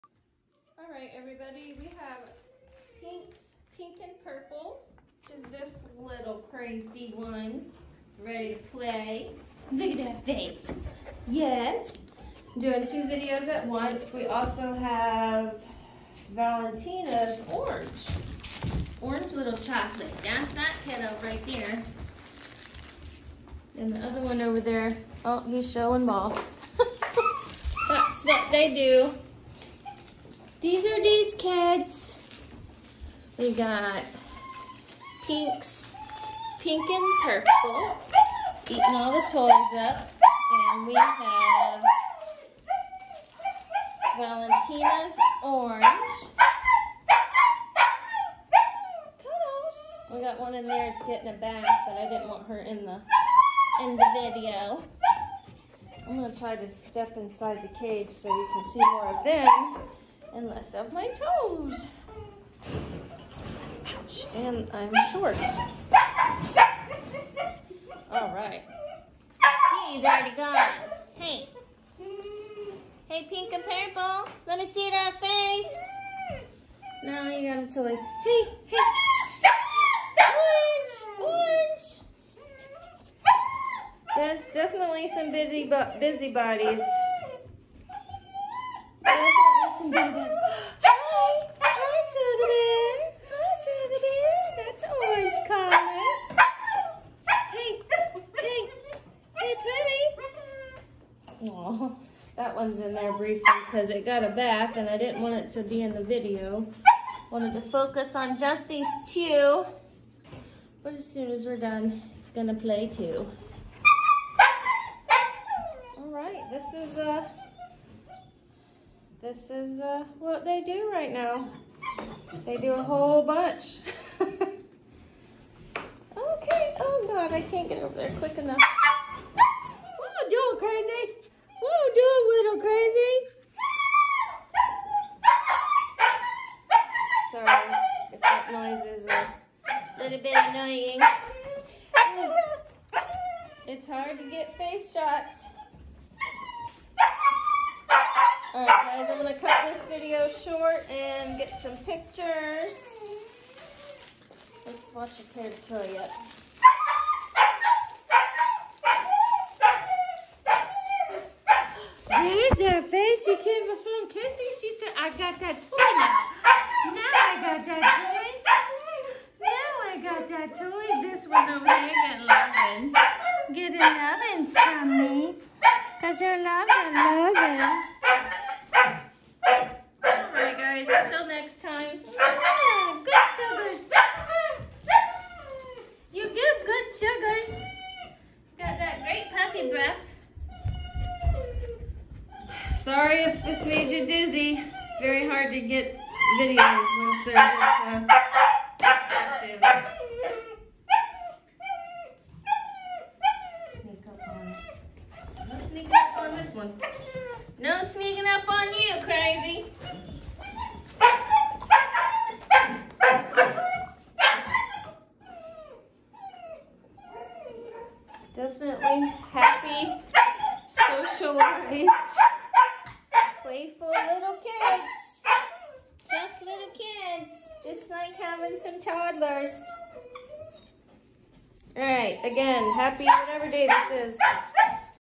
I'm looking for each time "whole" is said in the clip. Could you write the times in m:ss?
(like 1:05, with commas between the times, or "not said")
2:02.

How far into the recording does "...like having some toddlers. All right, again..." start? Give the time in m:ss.
3:47.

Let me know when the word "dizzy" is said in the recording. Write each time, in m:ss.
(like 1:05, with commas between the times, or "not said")
3:14.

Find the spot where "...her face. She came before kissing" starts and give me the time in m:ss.
2:42.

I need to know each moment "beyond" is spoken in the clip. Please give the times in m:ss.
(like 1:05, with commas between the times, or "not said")
not said.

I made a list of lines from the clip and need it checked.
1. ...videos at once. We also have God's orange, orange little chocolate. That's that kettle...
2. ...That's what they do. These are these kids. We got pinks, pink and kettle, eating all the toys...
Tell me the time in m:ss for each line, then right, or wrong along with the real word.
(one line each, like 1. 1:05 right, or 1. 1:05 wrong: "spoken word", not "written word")
1. 0:13 wrong: "Valentina", not "God"
2. 0:27 wrong: "purple", not "kettle".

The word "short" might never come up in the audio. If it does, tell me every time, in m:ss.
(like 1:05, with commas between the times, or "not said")
1:05, 2:30.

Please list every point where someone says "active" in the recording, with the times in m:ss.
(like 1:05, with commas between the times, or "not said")
3:18.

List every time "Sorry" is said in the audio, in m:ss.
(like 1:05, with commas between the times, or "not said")
2:17, 3:12.